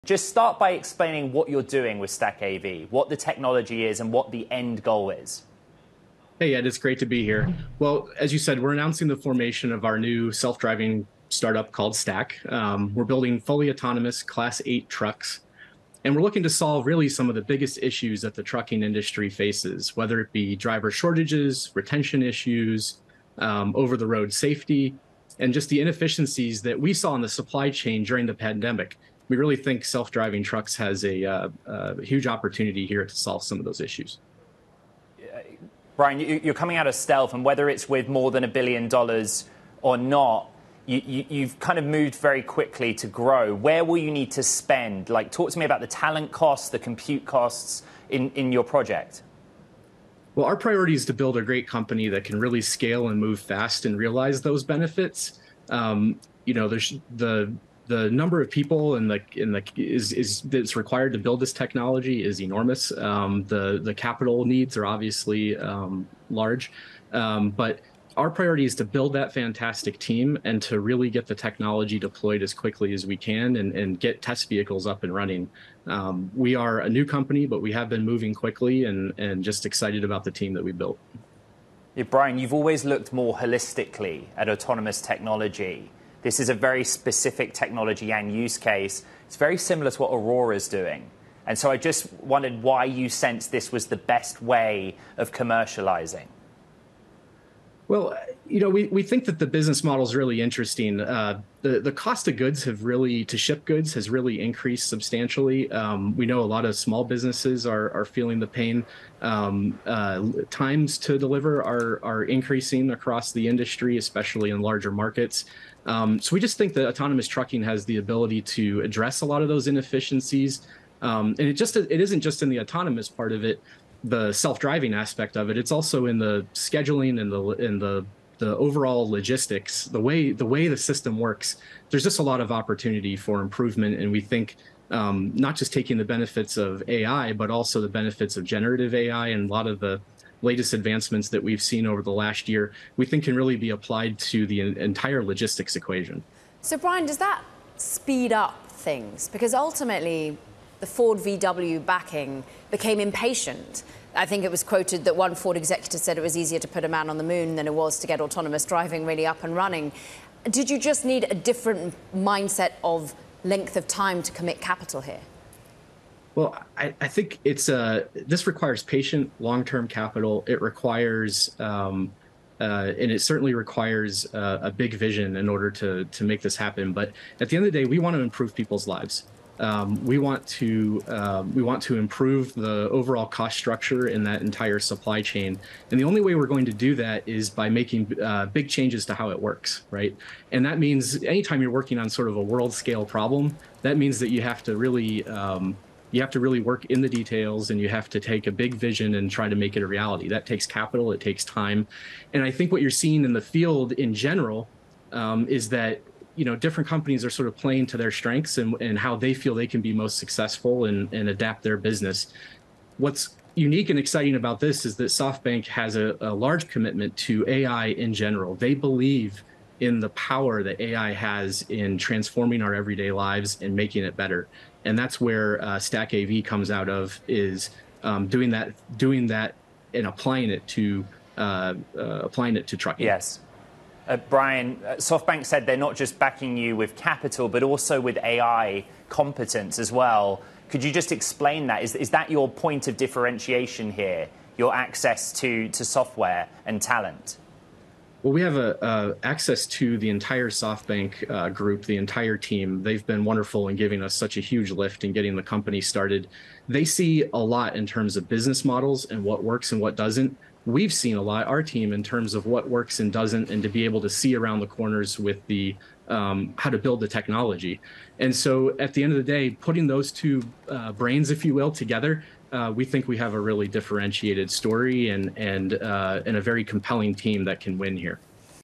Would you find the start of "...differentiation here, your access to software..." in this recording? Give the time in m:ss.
4:02.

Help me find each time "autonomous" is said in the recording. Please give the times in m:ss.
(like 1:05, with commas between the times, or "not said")
0:13, 1:24, 1:56, 2:02, 2:38.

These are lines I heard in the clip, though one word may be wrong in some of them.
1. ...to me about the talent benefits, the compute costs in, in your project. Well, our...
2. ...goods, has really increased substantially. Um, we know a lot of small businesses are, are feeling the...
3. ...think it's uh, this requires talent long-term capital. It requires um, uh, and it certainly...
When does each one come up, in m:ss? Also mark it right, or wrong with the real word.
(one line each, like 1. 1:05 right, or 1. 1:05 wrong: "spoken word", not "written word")
1. 0:45 wrong: "costs", not "benefits"
2. 1:43 right
3. 2:47 wrong: "patient", not "talent".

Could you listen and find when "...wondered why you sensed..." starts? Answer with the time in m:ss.
1:32.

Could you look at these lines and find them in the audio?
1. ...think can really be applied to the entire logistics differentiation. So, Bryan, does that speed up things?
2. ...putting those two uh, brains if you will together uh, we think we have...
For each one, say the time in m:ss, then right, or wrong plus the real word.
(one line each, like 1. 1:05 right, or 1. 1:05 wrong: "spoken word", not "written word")
1. 2:23 wrong: "equation", not "differentiation"
2. 4:29 right.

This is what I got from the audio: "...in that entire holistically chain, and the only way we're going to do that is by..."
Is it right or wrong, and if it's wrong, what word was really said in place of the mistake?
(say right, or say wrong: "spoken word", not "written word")
wrong: "supply", not "holistically".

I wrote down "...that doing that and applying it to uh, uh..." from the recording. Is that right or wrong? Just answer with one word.
right.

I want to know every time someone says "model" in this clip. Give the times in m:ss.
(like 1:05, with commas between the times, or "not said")
1:39, 4:18.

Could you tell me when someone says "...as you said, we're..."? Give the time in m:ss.
0:08.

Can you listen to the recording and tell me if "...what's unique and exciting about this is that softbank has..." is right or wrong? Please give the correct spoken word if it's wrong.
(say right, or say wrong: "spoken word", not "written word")
right.